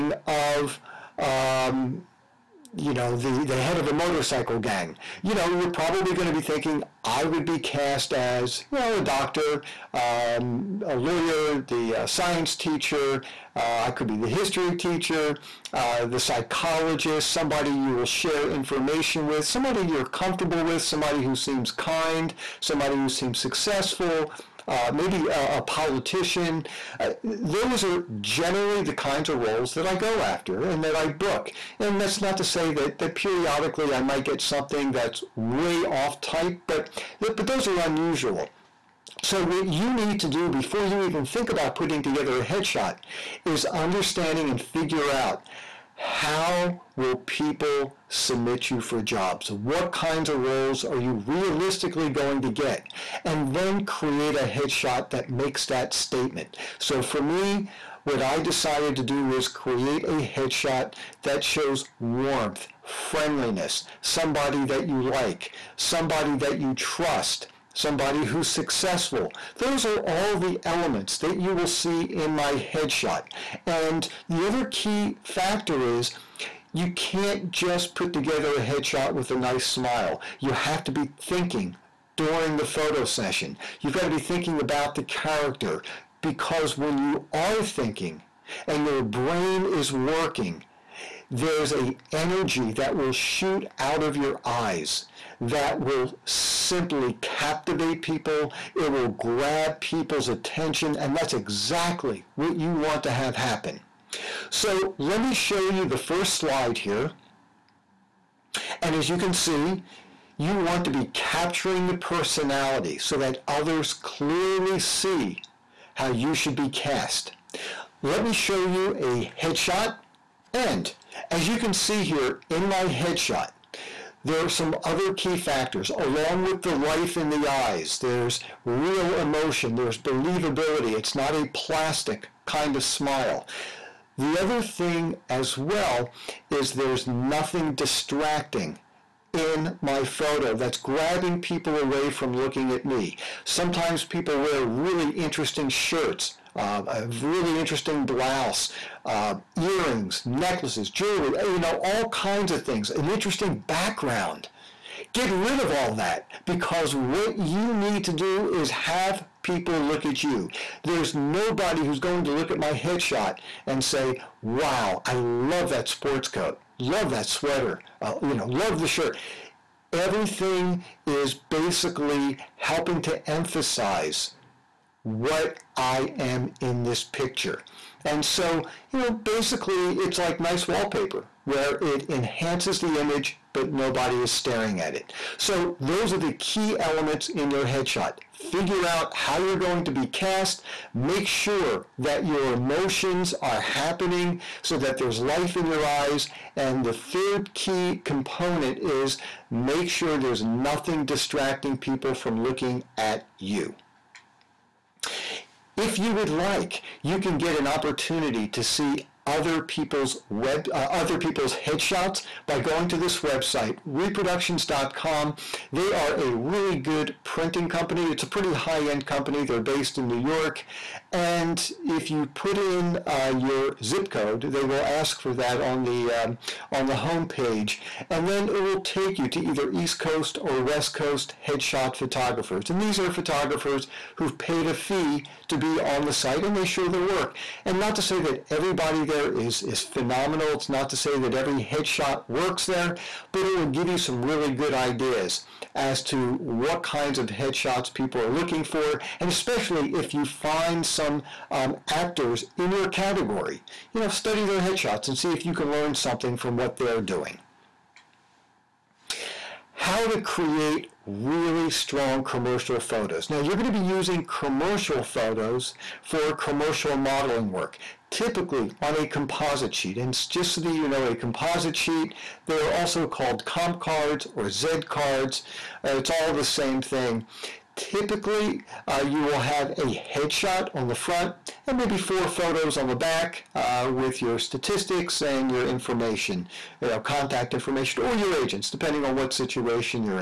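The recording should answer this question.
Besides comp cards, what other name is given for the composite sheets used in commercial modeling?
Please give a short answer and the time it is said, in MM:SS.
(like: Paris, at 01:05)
Z cards, at 04:34.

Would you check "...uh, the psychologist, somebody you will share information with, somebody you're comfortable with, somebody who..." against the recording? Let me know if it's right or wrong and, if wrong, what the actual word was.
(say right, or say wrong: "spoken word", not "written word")
right.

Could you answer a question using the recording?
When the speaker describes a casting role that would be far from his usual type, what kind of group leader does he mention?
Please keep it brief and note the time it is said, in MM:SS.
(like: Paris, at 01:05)
Head of a motorcycle gang, at 00:03.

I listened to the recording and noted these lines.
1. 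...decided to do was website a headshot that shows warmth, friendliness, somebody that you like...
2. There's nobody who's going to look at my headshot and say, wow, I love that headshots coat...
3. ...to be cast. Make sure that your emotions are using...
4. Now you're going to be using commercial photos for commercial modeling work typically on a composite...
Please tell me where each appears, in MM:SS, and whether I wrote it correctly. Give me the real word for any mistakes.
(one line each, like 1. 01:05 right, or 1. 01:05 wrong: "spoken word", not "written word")
1. 00:58 wrong: "create", not "website"
2. 02:40 wrong: "sports", not "headshots"
3. 03:09 wrong: "happening", not "using"
4. 04:23 right.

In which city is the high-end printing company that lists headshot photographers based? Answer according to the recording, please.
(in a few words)
New York.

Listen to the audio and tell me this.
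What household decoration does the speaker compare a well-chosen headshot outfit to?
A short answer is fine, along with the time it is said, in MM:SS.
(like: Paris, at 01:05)
Nice wallpaper, at 03:00.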